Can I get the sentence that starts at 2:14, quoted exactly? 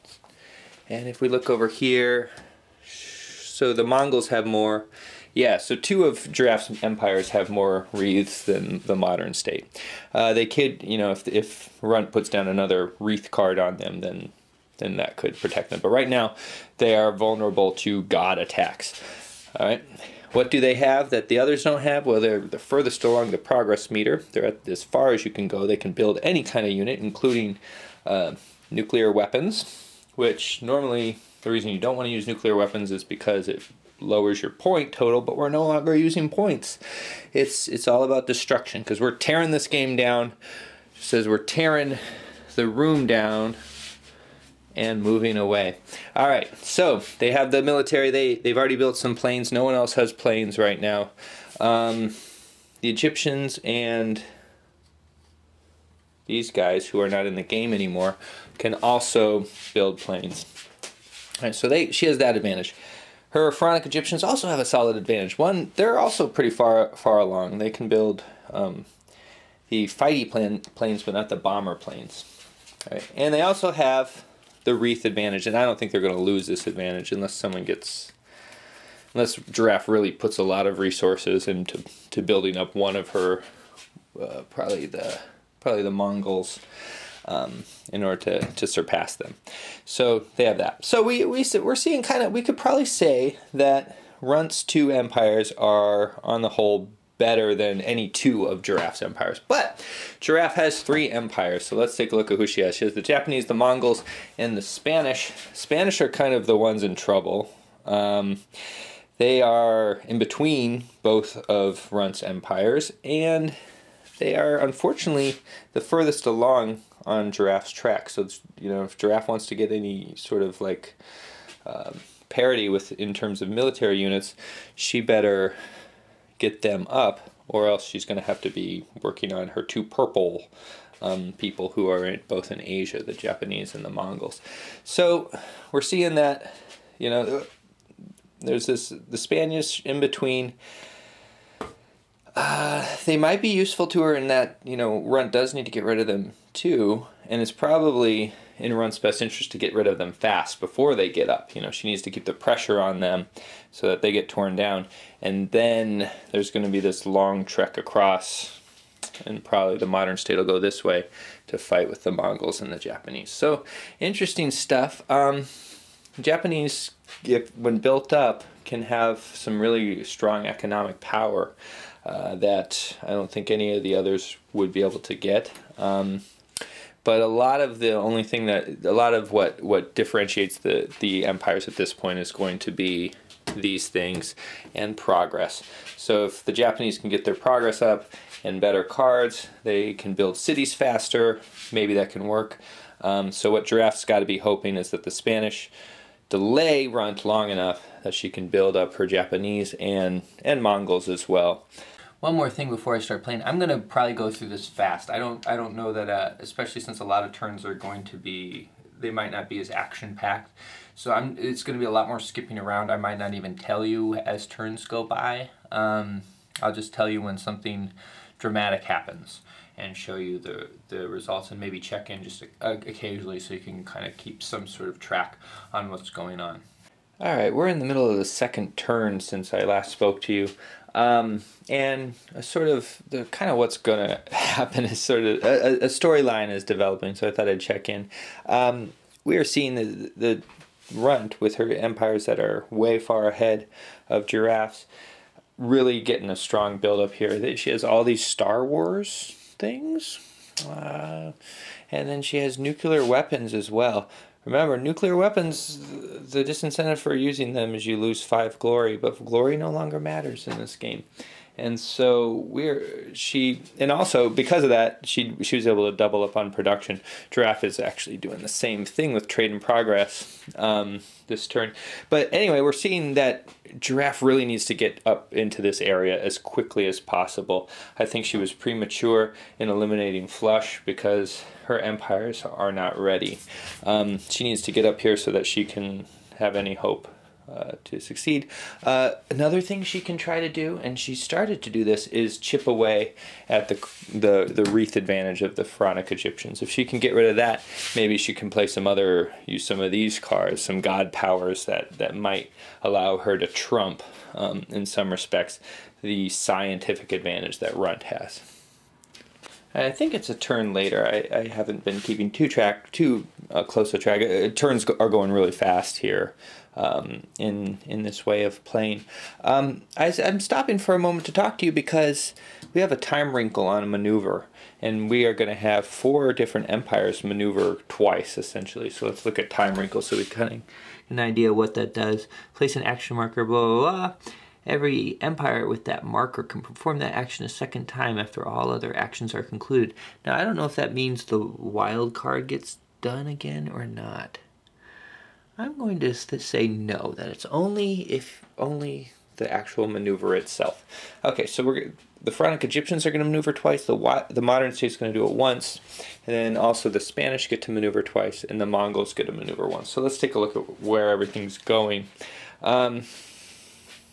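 So we're seeing that, you know, there's this the Spaniards in between.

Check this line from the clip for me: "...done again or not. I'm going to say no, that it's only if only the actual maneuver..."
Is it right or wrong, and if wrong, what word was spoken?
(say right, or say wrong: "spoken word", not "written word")
right.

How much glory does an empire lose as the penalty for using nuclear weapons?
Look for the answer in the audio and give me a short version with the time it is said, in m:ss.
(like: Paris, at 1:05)
5, at 4:18.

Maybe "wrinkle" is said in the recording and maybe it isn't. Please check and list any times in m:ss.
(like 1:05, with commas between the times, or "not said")
5:23, 5:29.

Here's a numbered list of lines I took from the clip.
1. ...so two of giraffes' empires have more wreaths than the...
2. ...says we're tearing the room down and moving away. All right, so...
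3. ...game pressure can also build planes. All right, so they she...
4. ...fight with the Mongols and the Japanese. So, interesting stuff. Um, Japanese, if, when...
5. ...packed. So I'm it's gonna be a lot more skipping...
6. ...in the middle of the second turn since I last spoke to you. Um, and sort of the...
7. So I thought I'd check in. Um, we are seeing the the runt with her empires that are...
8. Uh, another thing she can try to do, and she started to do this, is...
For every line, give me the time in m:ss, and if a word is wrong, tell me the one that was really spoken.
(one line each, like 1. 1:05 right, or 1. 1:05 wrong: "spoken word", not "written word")
1. 0:05 right
2. 0:41 right
3. 0:57 wrong: "anymore", not "pressure"
4. 2:41 right
5. 3:30 right
6. 3:47 right
7. 3:57 right
8. 4:48 right.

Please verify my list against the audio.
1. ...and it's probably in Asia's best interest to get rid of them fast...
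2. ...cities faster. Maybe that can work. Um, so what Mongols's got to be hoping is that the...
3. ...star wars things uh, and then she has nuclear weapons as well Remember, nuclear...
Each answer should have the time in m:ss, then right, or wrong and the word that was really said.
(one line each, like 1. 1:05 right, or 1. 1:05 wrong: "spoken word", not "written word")
1. 2:27 wrong: "Run", not "Asia"
2. 3:10 wrong: "Giraffe", not "Mongols"
3. 4:08 right.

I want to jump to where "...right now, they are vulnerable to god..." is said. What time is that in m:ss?
0:15.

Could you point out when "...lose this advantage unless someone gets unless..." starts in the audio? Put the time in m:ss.
1:16.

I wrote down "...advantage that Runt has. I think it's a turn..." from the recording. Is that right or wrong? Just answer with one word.
right.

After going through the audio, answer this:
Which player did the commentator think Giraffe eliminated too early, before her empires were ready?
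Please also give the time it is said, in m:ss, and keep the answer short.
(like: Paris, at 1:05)
Flush, at 4:40.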